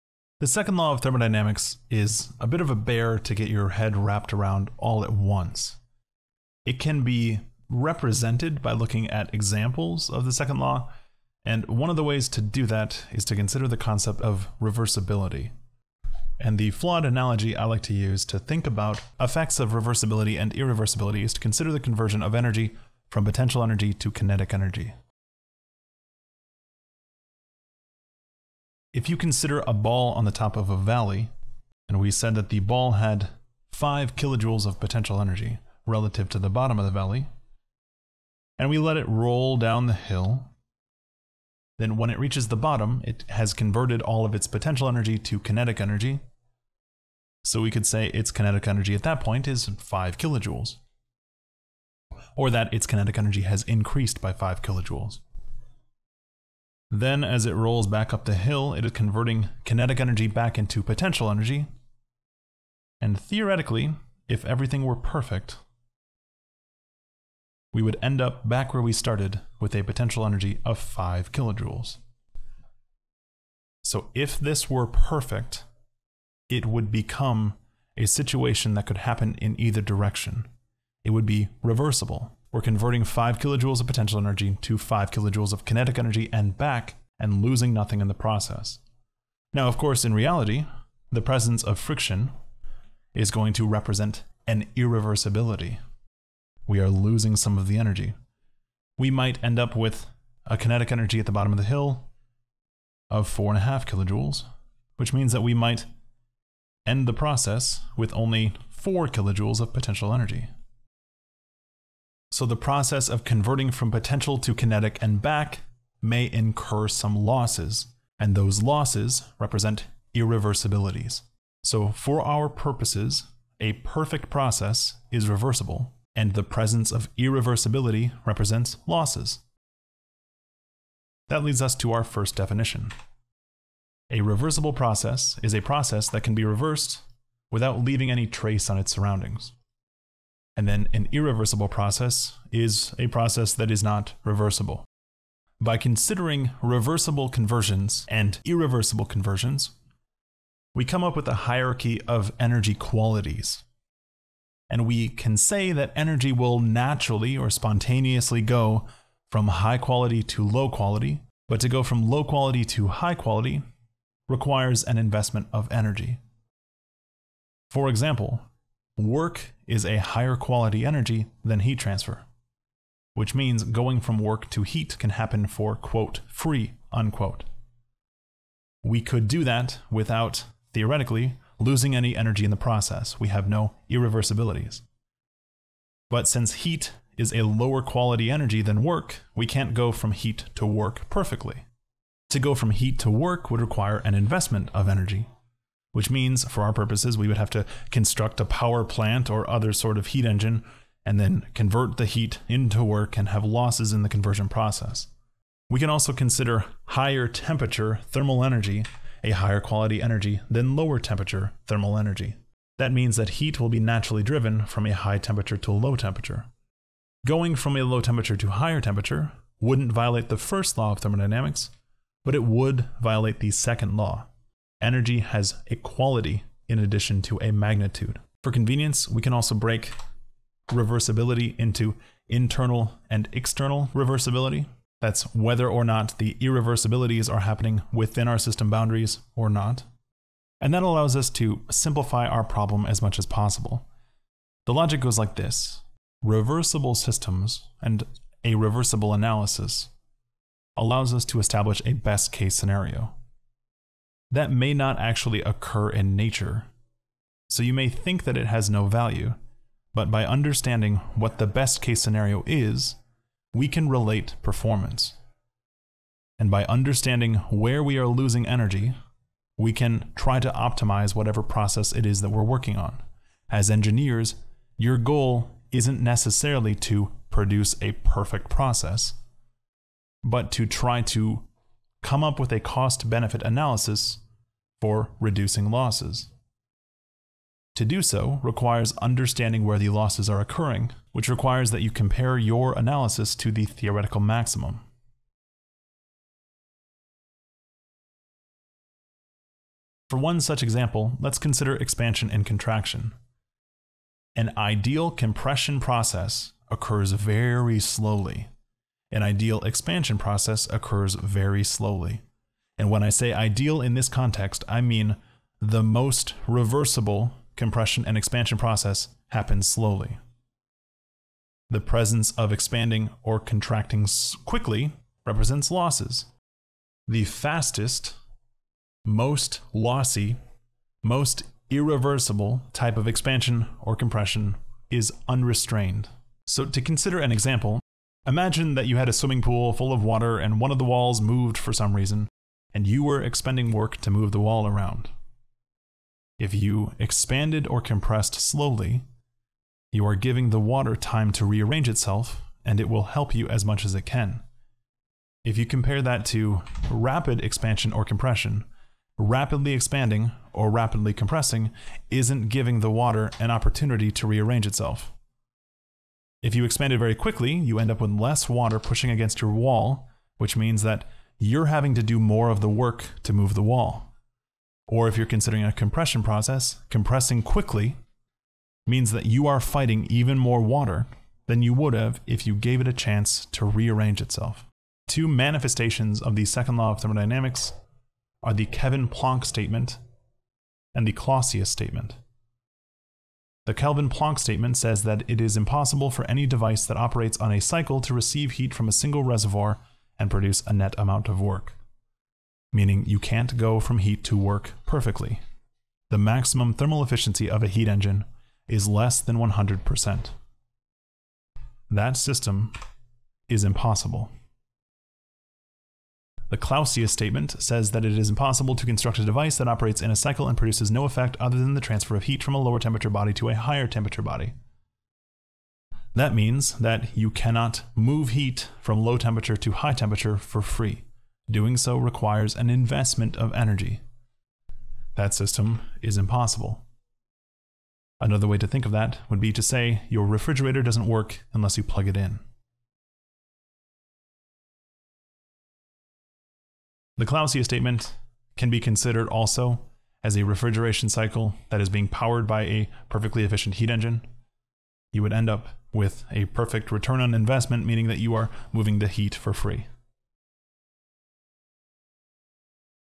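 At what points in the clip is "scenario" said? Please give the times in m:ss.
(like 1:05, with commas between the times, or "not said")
4:12, 4:22.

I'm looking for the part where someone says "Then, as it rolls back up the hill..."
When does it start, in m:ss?
0:56.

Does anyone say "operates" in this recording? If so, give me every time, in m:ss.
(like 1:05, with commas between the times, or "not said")
6:36, 6:59.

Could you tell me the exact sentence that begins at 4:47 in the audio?
To do so requires understanding where the losses are occurring, which requires that you compare your analysis to the theoretical maximum.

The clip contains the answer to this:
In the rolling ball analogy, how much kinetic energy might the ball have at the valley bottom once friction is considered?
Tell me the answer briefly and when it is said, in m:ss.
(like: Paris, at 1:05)
4.5 kilojoules, at 1:43.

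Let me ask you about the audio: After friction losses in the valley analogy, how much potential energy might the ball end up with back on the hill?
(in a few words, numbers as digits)
4 kilojoules.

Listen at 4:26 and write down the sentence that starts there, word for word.
And by understanding where we are losing energy, we can try to optimize whatever process it is that we're working on.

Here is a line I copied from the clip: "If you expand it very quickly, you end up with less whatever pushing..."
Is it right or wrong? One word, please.
wrong.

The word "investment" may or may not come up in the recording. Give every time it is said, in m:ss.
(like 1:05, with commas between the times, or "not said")
2:44, 3:14, 7:12, 7:37.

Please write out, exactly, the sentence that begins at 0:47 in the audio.
So we could say its kinetic energy at that point is 5 kilojoules.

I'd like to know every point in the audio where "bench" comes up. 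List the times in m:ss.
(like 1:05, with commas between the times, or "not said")
not said.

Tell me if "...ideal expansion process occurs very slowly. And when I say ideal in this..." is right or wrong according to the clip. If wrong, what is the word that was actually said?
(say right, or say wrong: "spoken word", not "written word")
right.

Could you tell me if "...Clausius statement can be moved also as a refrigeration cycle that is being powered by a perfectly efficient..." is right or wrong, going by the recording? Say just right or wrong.
wrong.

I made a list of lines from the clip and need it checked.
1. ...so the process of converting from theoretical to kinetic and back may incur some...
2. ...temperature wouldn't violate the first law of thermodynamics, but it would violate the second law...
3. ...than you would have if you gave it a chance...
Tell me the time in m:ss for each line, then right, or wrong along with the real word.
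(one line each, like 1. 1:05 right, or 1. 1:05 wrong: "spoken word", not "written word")
1. 1:52 wrong: "potential", not "theoretical"
2. 3:38 right
3. 6:21 right.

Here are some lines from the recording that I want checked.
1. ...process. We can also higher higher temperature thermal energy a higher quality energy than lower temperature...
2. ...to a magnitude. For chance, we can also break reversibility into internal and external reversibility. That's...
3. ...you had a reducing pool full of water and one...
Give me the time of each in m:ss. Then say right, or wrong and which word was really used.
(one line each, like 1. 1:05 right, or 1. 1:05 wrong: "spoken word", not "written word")
1. 3:24 wrong: "consider", not "higher"
2. 3:47 wrong: "convenience", not "chance"
3. 5:38 wrong: "swimming", not "reducing".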